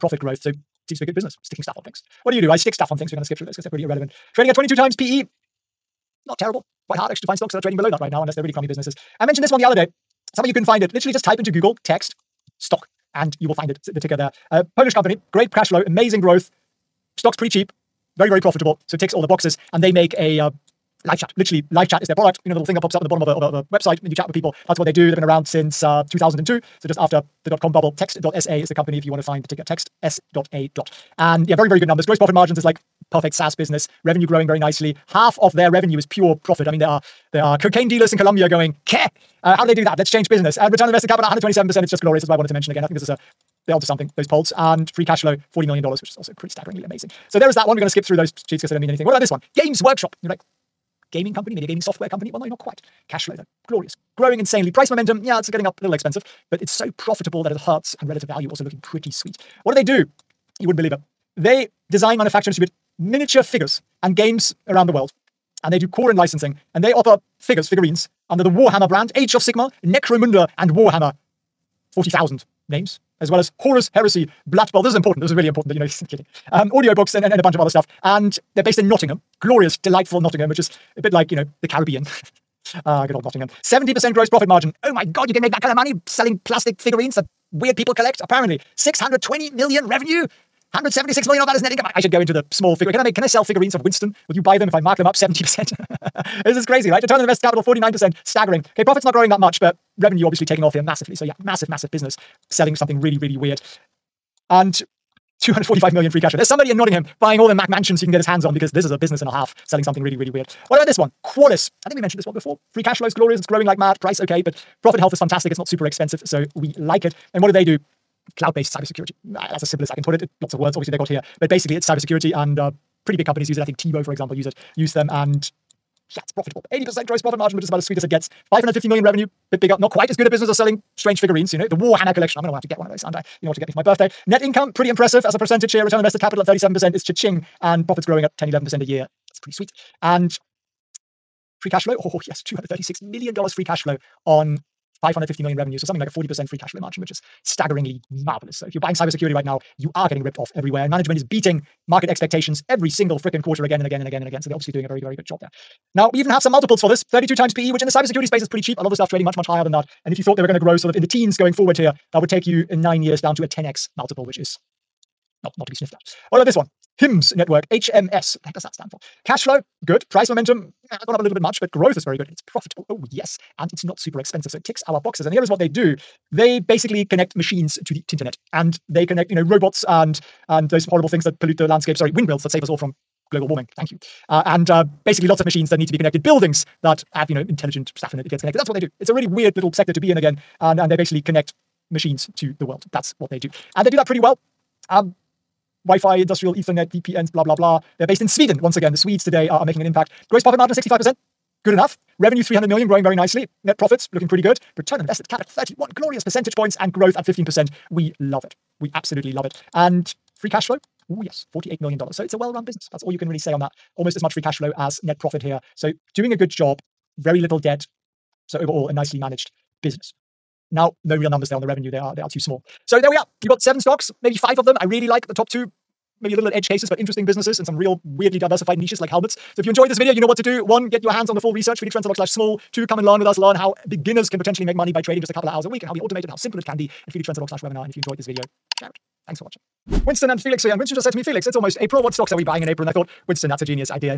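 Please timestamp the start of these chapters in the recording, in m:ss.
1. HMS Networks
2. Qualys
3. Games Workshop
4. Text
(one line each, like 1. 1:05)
1. 2:46
2. 1:50
3. 0:49
4. 0:09.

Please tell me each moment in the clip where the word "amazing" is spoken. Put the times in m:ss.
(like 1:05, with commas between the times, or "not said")
0:15, 0:46.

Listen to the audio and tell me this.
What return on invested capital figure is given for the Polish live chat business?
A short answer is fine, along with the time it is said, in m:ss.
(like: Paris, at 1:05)
127%, at 0:41.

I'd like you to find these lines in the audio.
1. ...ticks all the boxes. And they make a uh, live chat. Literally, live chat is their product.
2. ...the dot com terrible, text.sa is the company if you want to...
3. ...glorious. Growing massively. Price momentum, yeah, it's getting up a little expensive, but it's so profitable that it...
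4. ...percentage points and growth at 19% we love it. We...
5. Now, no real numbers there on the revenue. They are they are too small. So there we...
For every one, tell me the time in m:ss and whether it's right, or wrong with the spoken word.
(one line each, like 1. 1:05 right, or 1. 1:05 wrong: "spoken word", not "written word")
1. 0:18 right
2. 0:27 wrong: "bubble", not "terrible"
3. 0:53 wrong: "insanely", not "massively"
4. 3:26 wrong: "15", not "19"
5. 3:40 right.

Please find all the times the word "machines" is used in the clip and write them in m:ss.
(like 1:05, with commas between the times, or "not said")
2:57, 3:05, 3:11.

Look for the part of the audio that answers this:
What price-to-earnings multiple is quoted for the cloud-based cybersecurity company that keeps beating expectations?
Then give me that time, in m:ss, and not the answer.
2:37.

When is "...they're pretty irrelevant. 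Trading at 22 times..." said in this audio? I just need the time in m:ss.
0:03.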